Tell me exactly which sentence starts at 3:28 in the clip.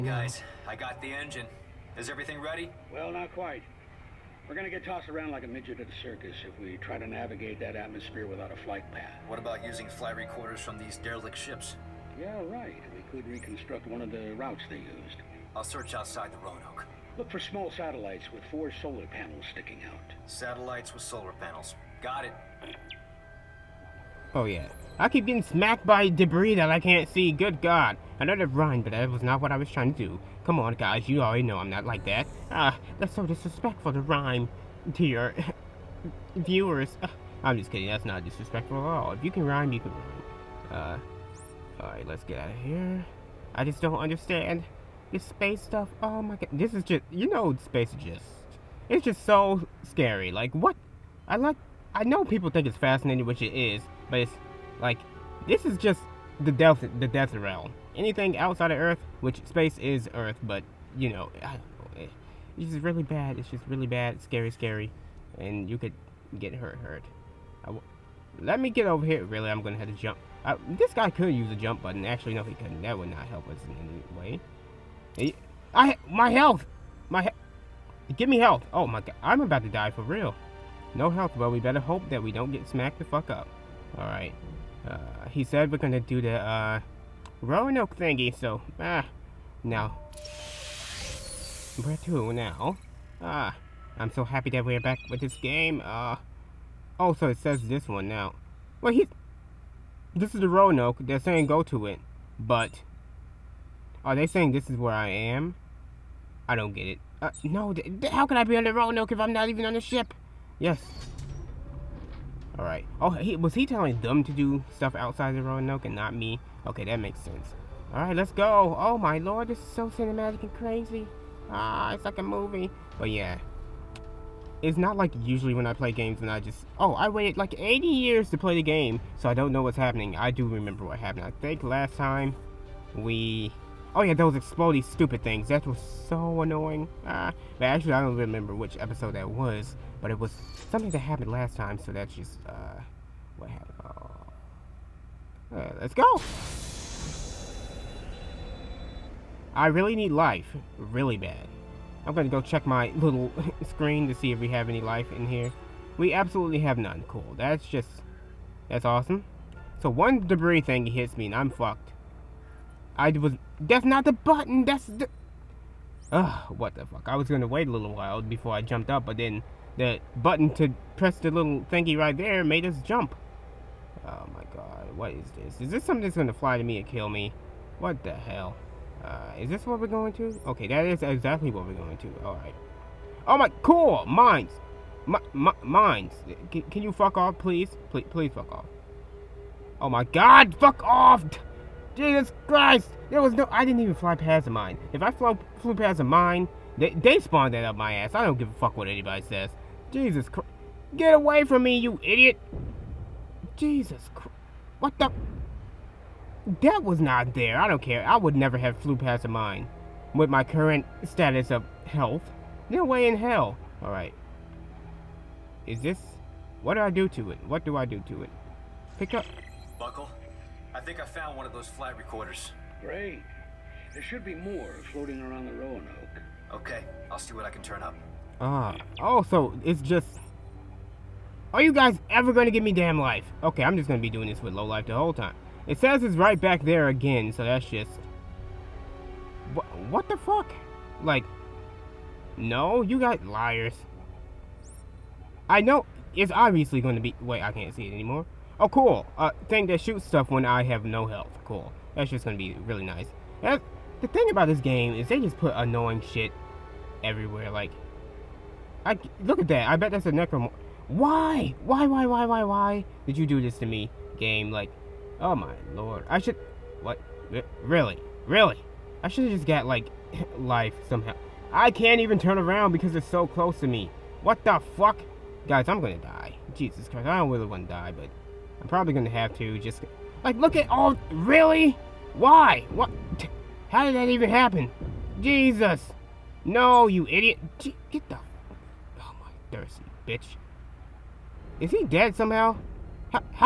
I would never have flew past a mine.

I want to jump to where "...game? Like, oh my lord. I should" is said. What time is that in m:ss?
4:24.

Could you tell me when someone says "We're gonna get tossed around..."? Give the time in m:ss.
0:04.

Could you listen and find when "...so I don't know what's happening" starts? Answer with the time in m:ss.
2:09.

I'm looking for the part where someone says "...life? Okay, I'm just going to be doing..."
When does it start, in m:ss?
3:52.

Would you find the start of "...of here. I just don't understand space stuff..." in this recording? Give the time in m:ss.
0:42.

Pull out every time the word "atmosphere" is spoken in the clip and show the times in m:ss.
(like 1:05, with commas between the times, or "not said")
0:07.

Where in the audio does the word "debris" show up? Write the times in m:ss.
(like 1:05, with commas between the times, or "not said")
0:26, 2:40.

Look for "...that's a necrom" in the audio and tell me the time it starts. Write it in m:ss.
4:19.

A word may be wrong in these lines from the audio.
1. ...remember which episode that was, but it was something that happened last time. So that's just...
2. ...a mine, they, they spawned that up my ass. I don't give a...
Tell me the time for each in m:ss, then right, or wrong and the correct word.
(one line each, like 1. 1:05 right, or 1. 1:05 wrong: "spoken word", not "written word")
1. 2:18 right
2. 3:15 right.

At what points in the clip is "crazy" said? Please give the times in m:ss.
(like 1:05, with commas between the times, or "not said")
2:00.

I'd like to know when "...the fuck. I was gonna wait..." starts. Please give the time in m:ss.
2:46.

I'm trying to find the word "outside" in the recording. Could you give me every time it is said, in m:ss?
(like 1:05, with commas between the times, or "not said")
0:15, 0:58, 1:54.